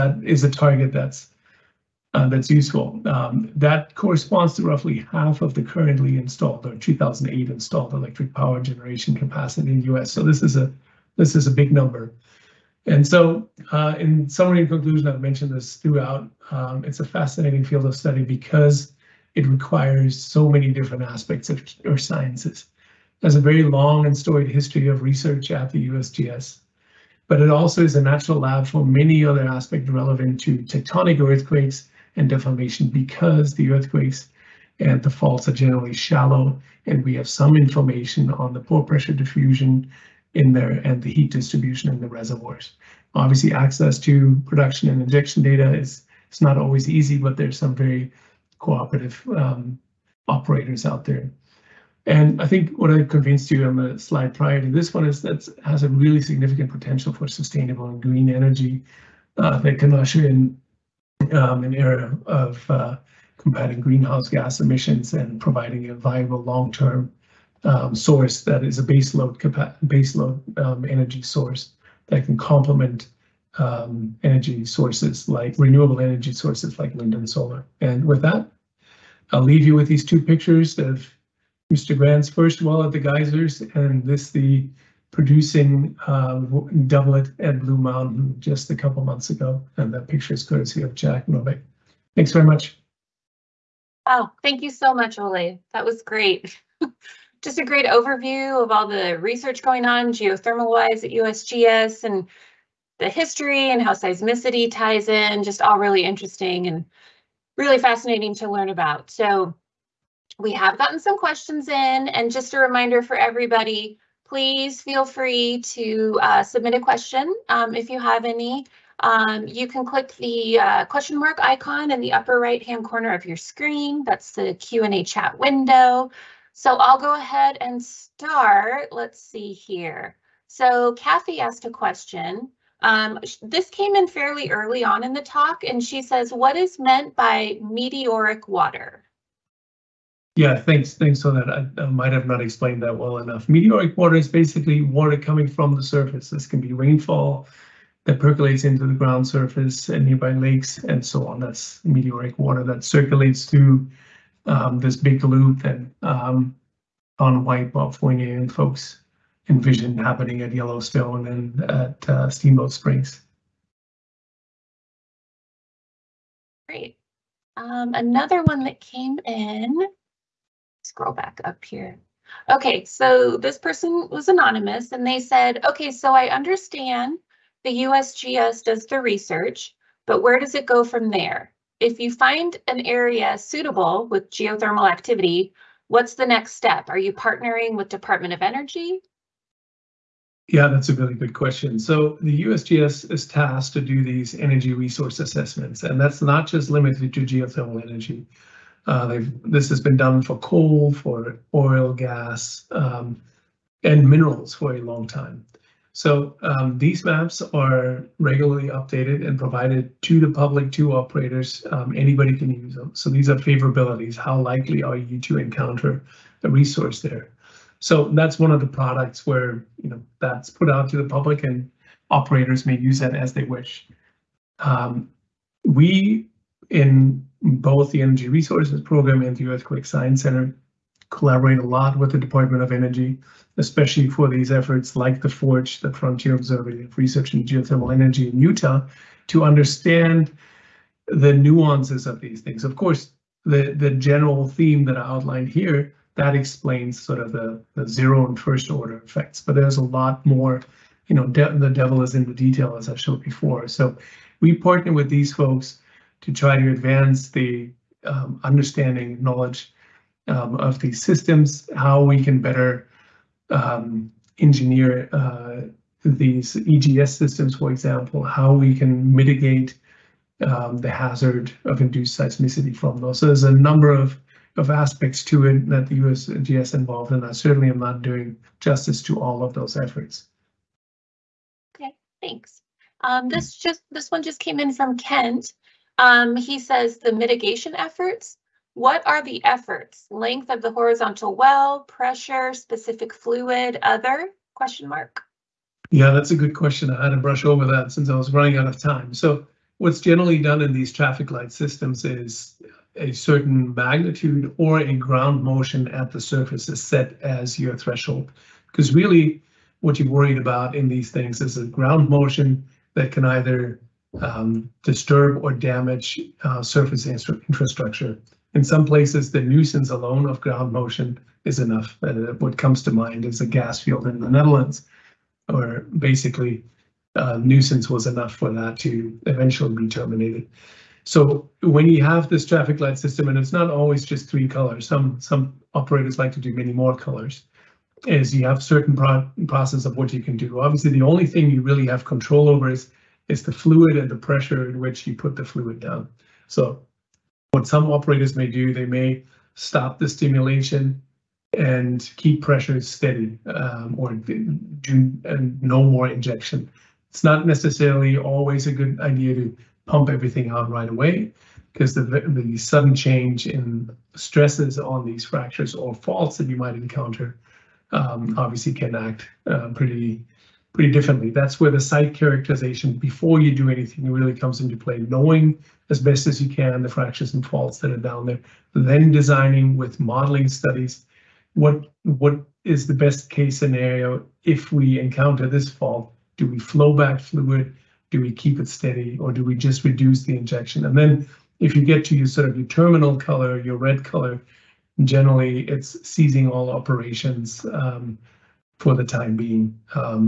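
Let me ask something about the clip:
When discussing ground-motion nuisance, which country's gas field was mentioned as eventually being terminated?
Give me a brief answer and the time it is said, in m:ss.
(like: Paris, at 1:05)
the Netherlands, at 5:24.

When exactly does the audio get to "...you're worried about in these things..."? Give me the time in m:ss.
5:10.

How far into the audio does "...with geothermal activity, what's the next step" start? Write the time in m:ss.
3:04.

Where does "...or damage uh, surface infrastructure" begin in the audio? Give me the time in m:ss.
5:15.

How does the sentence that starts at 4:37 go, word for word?
I certainly am not doing justice to all of those efforts.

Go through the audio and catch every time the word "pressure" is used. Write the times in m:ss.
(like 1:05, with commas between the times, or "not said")
0:38, 4:51, 5:44, 5:52.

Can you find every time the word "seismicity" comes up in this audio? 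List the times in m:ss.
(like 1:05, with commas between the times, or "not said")
1:43, 4:32.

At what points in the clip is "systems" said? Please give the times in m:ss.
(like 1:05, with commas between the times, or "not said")
4:21, 4:27, 5:01, 5:32.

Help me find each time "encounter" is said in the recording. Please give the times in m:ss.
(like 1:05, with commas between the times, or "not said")
3:35, 6:06, 6:24.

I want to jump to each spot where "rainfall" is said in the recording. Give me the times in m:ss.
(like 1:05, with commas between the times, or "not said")
2:26.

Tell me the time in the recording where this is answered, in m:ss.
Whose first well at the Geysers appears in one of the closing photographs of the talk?
1:21.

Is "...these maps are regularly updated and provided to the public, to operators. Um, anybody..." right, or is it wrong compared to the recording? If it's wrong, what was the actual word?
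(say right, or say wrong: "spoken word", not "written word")
right.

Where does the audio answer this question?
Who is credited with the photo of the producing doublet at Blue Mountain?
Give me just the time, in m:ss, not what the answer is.
1:30.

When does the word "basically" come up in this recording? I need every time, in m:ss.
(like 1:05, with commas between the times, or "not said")
2:24, 5:25.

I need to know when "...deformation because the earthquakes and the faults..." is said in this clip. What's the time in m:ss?
0:32.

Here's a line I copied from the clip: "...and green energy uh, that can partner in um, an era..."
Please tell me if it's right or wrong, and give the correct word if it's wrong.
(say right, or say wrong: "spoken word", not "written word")
wrong: "usher", not "partner".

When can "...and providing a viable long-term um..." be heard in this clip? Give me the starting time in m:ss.
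1:05.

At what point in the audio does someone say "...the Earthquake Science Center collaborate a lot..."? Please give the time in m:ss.
3:49.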